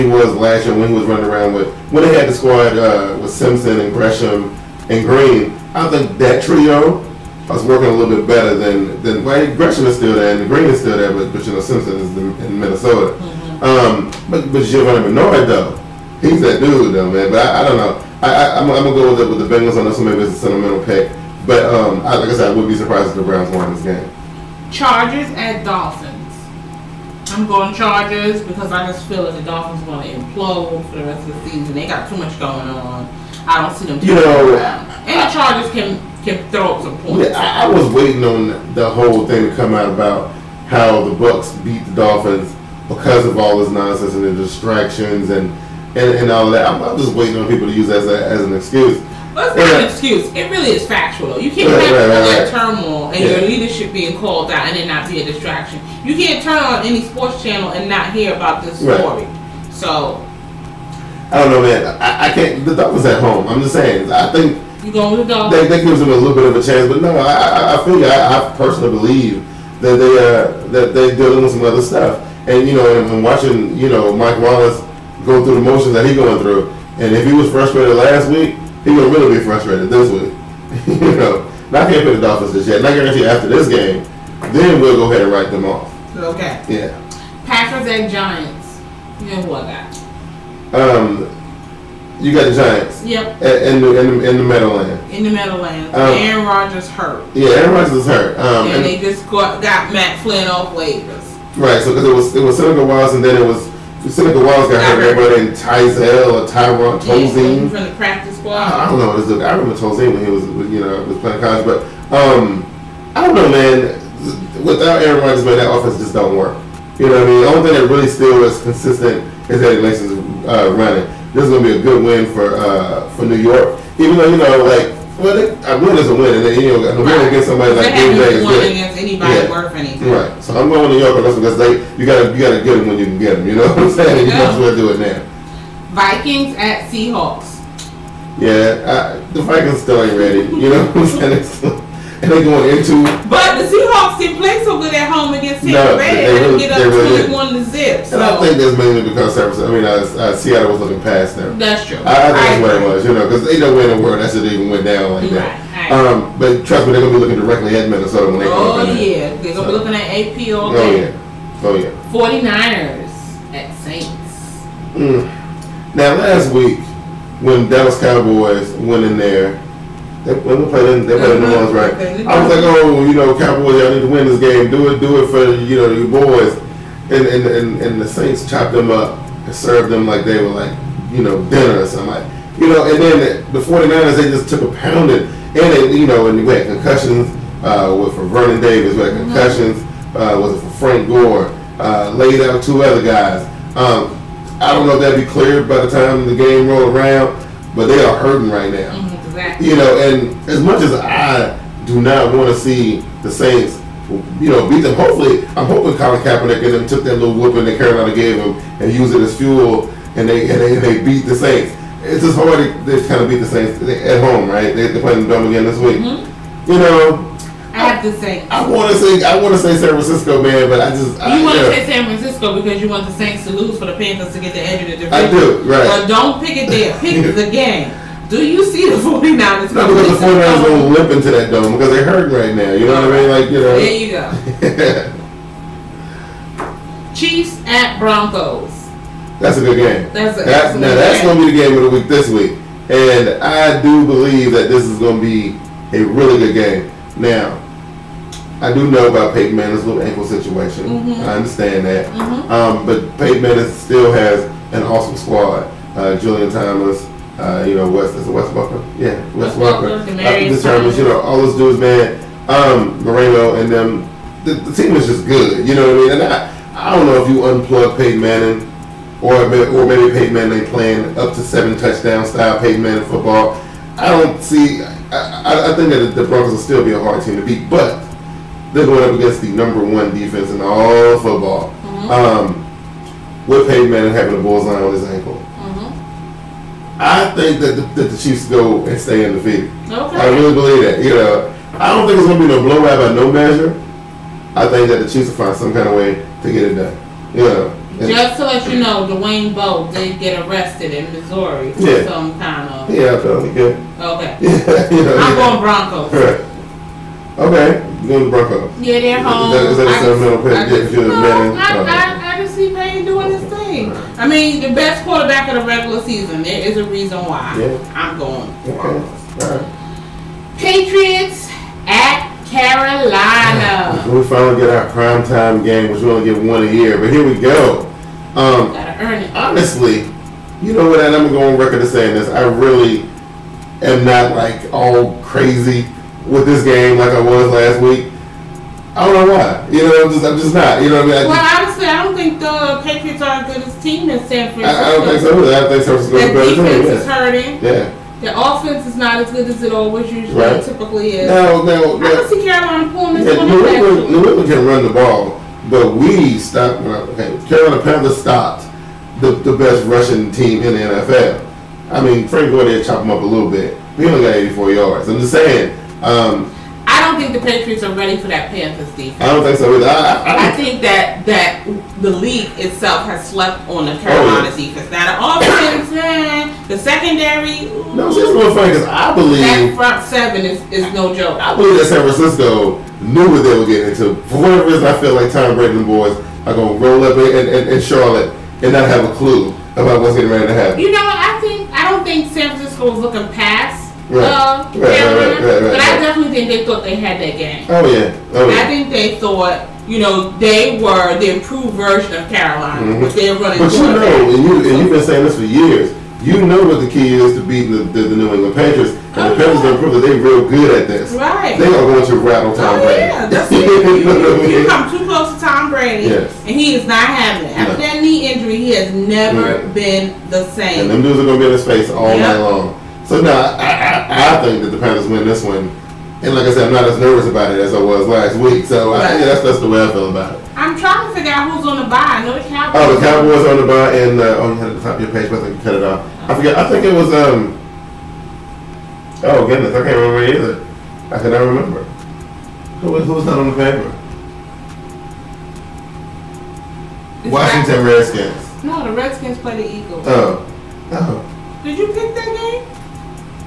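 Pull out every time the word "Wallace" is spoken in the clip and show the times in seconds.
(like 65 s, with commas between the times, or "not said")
74 s, 102 s.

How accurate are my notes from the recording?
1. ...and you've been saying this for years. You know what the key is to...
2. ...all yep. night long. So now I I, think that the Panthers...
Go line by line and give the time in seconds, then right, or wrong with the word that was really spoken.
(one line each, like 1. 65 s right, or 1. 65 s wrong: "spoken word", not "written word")
1. 404 s right
2. 421 s right.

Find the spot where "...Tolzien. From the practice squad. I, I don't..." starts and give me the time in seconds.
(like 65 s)
106 s.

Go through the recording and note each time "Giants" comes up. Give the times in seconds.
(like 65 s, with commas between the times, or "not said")
88 s, 92 s.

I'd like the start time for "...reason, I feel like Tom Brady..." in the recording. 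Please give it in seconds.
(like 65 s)
384 s.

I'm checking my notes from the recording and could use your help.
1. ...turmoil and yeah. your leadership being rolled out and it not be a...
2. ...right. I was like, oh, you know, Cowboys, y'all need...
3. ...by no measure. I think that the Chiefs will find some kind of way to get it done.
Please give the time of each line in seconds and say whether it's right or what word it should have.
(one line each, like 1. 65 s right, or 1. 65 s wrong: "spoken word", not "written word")
1. 52 s wrong: "called", not "rolled"
2. 171 s right
3. 292 s right.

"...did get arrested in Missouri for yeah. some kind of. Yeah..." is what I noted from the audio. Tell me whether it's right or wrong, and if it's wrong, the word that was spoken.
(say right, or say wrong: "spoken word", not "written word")
right.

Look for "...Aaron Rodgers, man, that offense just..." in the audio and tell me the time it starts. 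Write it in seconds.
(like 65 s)
115 s.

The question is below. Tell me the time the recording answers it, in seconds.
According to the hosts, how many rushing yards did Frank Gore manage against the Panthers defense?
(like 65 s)
364 s.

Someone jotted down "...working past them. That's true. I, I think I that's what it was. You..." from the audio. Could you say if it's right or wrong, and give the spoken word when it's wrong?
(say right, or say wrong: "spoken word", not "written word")
wrong: "looking", not "working".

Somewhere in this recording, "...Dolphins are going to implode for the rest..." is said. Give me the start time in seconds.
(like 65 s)
29 s.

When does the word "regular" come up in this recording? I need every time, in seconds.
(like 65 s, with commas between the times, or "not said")
315 s.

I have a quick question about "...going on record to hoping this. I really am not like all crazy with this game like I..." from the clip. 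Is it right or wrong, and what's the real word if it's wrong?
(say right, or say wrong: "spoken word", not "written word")
wrong: "saying", not "hoping".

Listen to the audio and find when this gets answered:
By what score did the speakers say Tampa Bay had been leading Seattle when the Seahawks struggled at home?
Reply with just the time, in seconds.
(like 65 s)
147 s.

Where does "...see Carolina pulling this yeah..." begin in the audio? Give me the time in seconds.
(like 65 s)
352 s.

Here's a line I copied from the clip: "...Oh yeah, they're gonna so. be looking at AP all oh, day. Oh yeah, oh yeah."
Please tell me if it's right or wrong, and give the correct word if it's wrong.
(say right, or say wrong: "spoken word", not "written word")
right.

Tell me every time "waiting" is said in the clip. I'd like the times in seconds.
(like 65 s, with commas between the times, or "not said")
37 s, 47 s.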